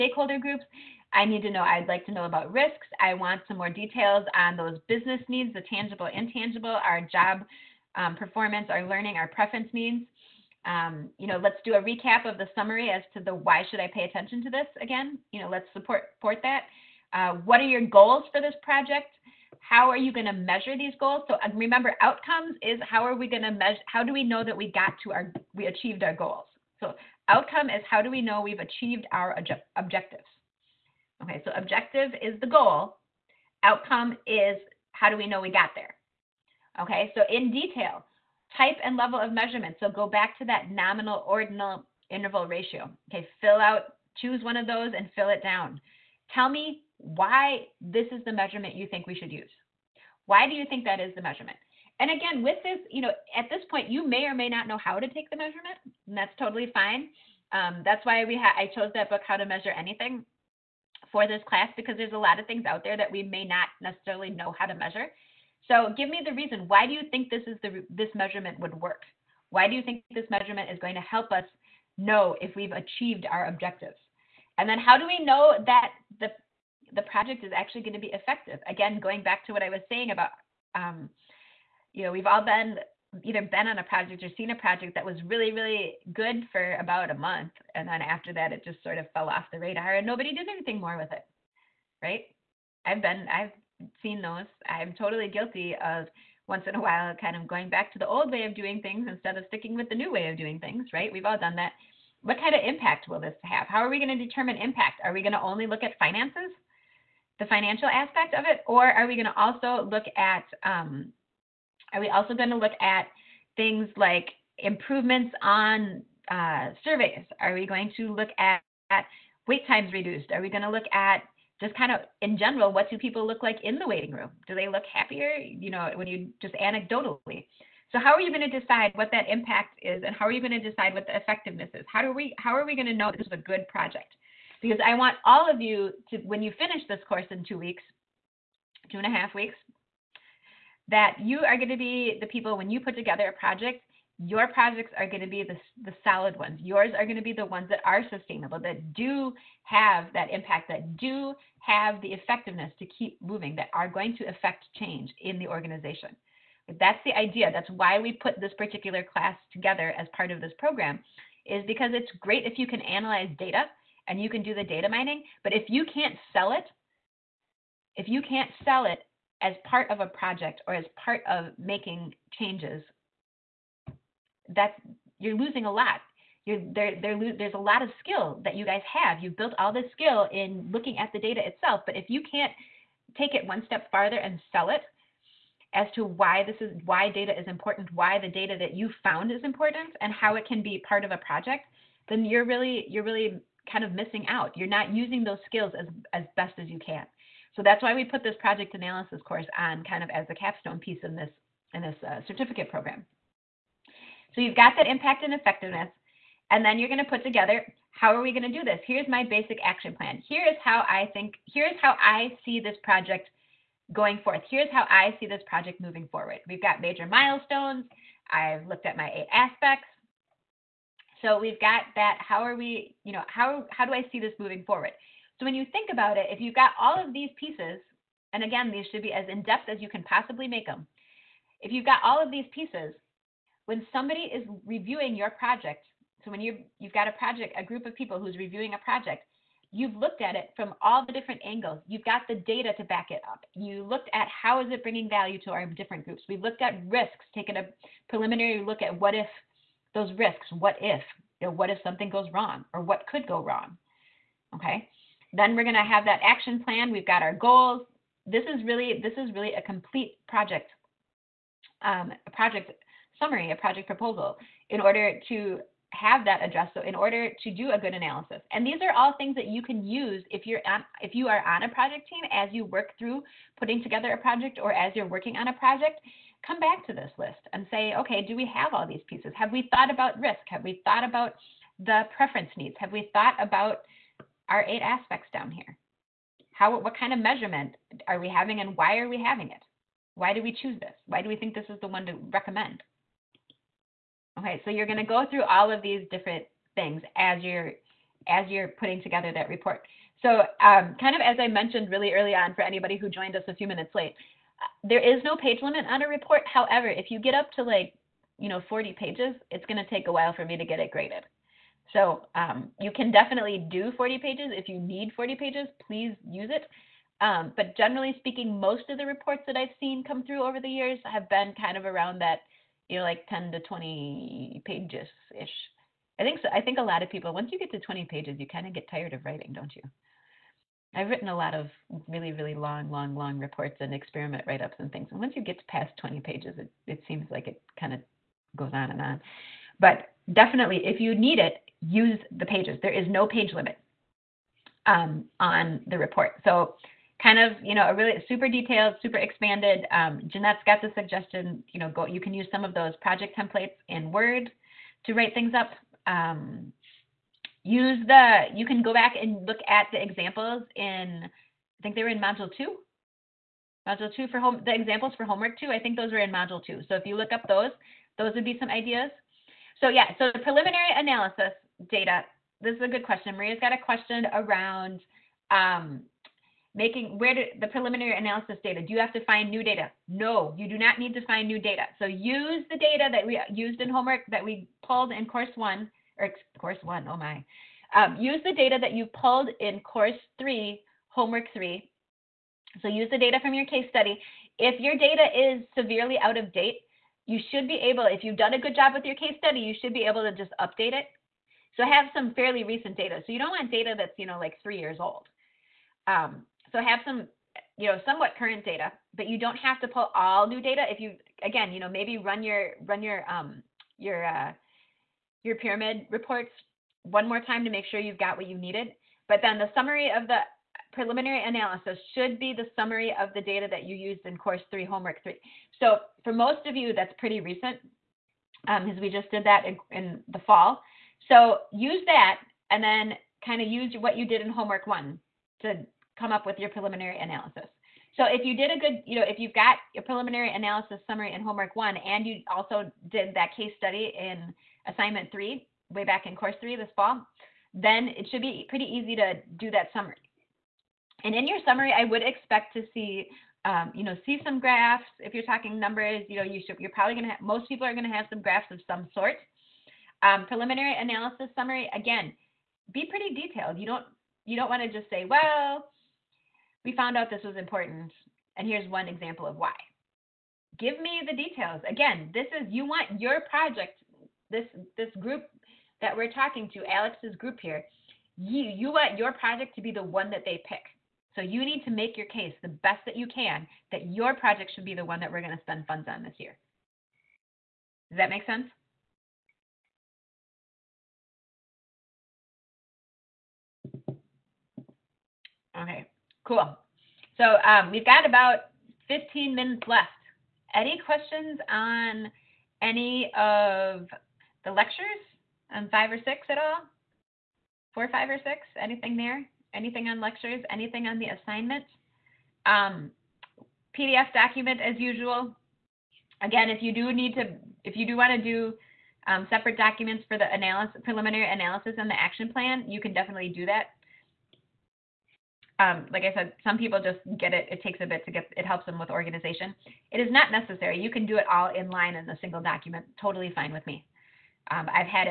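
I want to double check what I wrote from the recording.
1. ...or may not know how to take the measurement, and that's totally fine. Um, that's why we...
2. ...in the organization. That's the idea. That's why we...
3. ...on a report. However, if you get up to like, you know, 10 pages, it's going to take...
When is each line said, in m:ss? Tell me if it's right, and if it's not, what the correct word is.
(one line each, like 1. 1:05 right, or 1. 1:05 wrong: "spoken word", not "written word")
1. 0:54 right
2. 2:35 right
3. 5:05 wrong: "40", not "10".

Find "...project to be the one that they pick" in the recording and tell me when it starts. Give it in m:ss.
7:59.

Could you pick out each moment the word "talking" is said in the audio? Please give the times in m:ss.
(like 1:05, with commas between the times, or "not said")
7:35, 7:56.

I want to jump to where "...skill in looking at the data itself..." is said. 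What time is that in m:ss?
2:59.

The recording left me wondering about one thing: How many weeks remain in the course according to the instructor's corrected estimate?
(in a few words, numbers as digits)
two and a half weeks.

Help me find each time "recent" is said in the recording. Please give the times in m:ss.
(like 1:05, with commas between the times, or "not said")
6:42, 7:07.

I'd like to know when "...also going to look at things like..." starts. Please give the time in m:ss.
1:52.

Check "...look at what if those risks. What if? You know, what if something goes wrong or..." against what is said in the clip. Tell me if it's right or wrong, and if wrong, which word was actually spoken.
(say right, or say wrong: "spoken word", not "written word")
right.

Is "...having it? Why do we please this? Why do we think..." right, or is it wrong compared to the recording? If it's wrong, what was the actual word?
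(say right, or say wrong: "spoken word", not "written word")
wrong: "choose", not "please".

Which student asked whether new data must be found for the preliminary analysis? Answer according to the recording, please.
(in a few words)
Maria.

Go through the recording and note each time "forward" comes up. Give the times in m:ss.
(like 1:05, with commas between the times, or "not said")
3:36, 3:44.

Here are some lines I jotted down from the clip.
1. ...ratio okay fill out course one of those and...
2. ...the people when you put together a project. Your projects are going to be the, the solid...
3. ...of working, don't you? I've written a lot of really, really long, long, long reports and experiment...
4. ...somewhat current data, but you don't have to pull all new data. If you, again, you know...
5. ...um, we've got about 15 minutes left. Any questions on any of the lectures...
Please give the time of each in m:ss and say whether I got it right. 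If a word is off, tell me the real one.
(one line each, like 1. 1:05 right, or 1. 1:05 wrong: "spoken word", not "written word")
1. 0:42 wrong: "choose", not "course"
2. 2:22 right
3. 5:29 wrong: "writing", not "working"
4. 6:48 right
5. 8:17 right.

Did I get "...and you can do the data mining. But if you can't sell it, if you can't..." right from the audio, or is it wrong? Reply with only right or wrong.
right.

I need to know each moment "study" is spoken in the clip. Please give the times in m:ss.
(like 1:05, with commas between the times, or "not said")
6:33, 6:39, 7:23.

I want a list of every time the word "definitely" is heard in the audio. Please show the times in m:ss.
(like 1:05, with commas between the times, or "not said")
5:13, 5:40, 8:43.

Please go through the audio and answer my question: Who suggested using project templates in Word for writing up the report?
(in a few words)
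Jeanette.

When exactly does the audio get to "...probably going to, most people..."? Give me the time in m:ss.
7:36.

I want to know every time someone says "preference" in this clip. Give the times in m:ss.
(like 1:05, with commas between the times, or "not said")
0:09, 4:42.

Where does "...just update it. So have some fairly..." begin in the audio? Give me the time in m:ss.
6:40.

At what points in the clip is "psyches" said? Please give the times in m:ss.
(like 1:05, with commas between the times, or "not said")
not said.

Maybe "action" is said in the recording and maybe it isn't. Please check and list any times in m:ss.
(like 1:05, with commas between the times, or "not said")
3:29, 4:16, 8:42.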